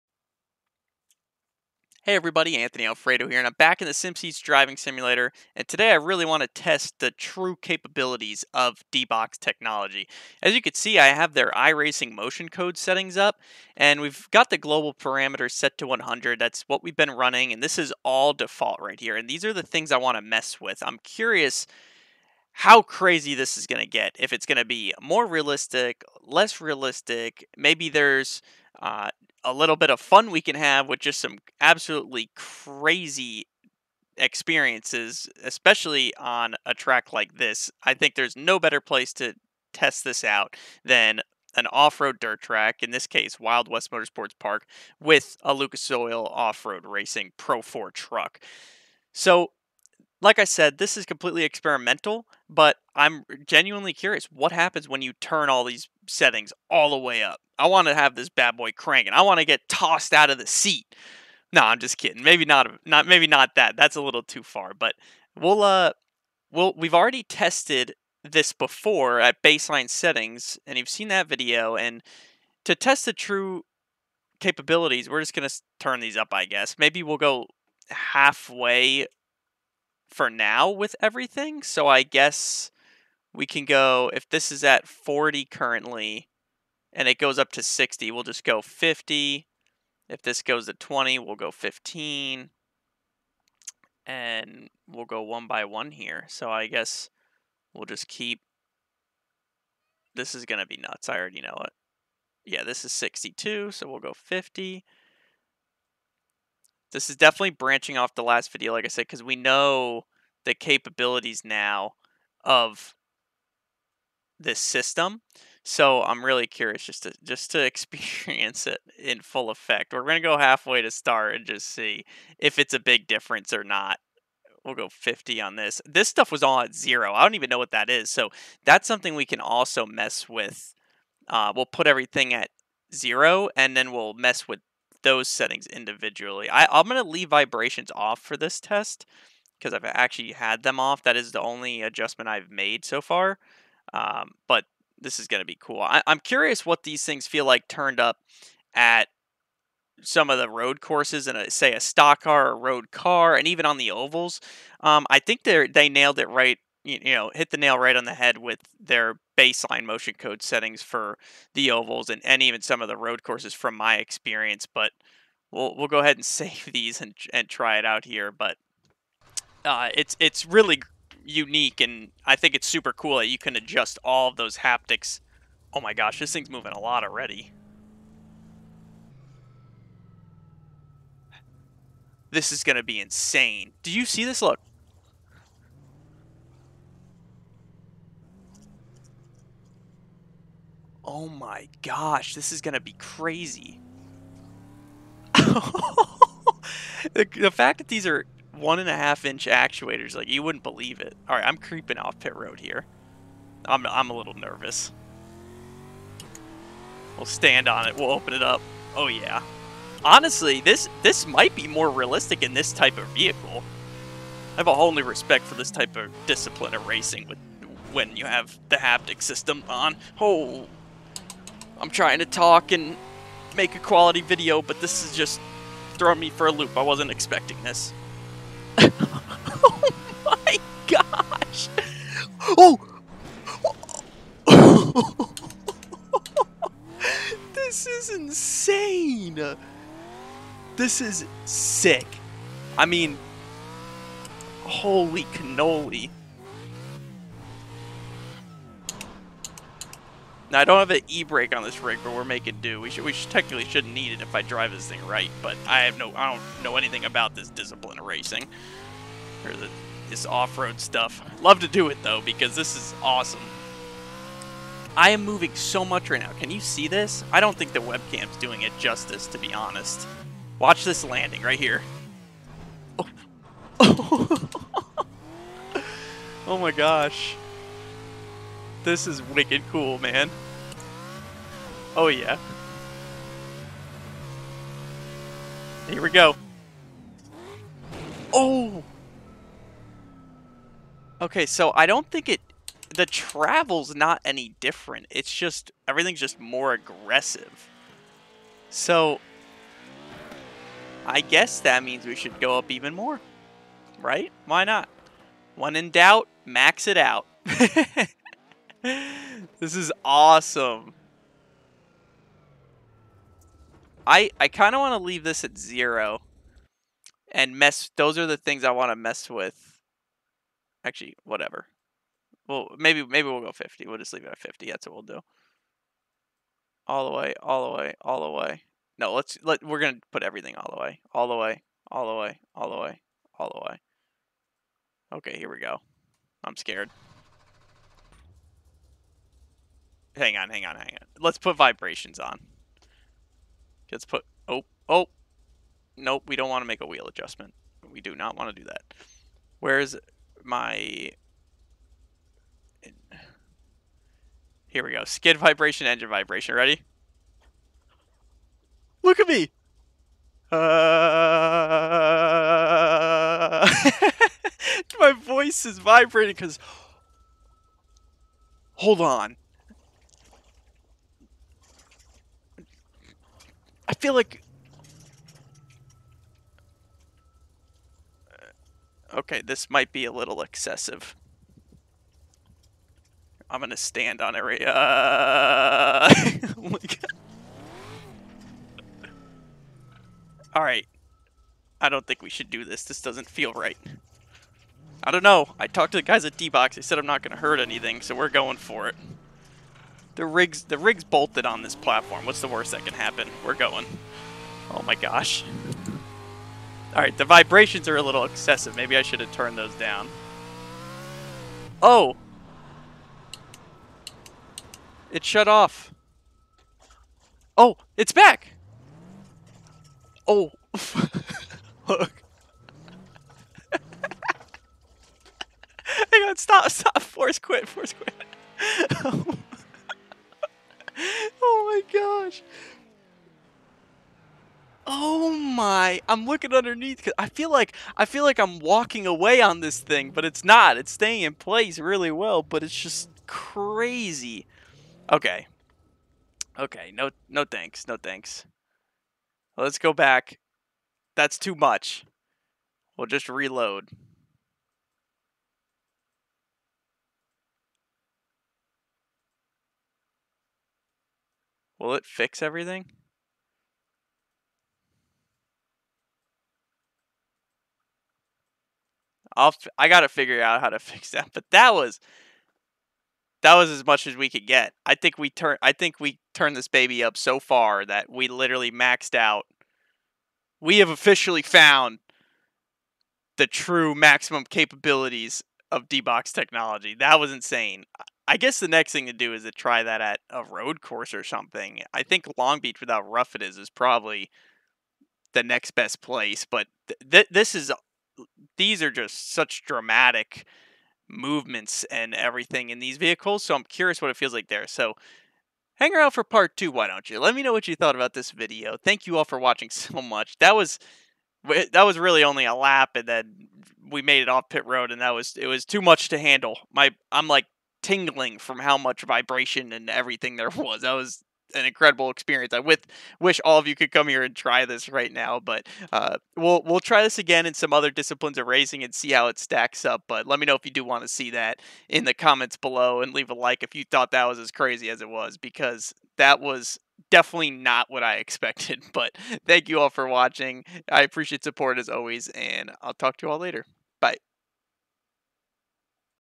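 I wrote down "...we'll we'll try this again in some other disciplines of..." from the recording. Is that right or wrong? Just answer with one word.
right.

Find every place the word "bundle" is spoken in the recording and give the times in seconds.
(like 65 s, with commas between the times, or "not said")
not said.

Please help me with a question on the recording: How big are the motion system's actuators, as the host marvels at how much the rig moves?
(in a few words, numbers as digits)
1.5 inches.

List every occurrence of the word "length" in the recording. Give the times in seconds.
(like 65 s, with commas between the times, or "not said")
not said.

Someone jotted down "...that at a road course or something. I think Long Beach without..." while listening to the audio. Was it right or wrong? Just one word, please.
right.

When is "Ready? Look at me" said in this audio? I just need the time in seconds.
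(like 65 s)
356 s.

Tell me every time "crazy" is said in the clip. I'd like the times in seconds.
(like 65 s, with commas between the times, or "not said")
22 s, 32 s, 192 s, 443 s, 534 s.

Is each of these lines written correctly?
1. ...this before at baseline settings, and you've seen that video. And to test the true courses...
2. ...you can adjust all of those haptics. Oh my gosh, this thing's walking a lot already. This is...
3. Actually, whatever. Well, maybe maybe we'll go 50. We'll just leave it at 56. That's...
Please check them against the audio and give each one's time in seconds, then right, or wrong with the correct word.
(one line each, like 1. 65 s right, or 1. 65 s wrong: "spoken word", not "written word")
1. 68 s wrong: "capabilities", not "courses"
2. 173 s wrong: "moving", not "walking"
3. 320 s wrong: "50", not "56".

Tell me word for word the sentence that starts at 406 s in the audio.
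Alright, the vibrations are a little excessive.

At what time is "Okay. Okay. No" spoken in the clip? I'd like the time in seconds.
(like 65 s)
445 s.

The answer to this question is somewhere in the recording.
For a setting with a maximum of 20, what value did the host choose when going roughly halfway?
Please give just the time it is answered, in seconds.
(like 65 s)
91 s.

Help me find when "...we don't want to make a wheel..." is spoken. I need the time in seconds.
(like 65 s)
346 s.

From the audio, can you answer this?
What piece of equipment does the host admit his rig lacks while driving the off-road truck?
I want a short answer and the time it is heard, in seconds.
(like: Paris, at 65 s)
e-brake, at 251 s.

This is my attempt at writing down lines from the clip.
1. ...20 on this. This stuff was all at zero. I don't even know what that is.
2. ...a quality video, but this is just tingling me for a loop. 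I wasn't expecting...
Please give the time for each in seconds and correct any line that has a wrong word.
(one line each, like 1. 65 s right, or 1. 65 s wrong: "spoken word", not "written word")
1. 124 s wrong: "50", not "20"
2. 223 s wrong: "throwing", not "tingling".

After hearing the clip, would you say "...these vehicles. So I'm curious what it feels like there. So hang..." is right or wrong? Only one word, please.
right.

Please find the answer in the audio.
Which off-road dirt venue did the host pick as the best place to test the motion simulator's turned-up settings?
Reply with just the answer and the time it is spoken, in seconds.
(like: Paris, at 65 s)
Wild West Motorsports Park, at 43 s.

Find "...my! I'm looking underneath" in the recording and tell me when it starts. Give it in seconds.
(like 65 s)
435 s.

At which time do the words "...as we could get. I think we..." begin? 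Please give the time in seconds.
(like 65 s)
474 s.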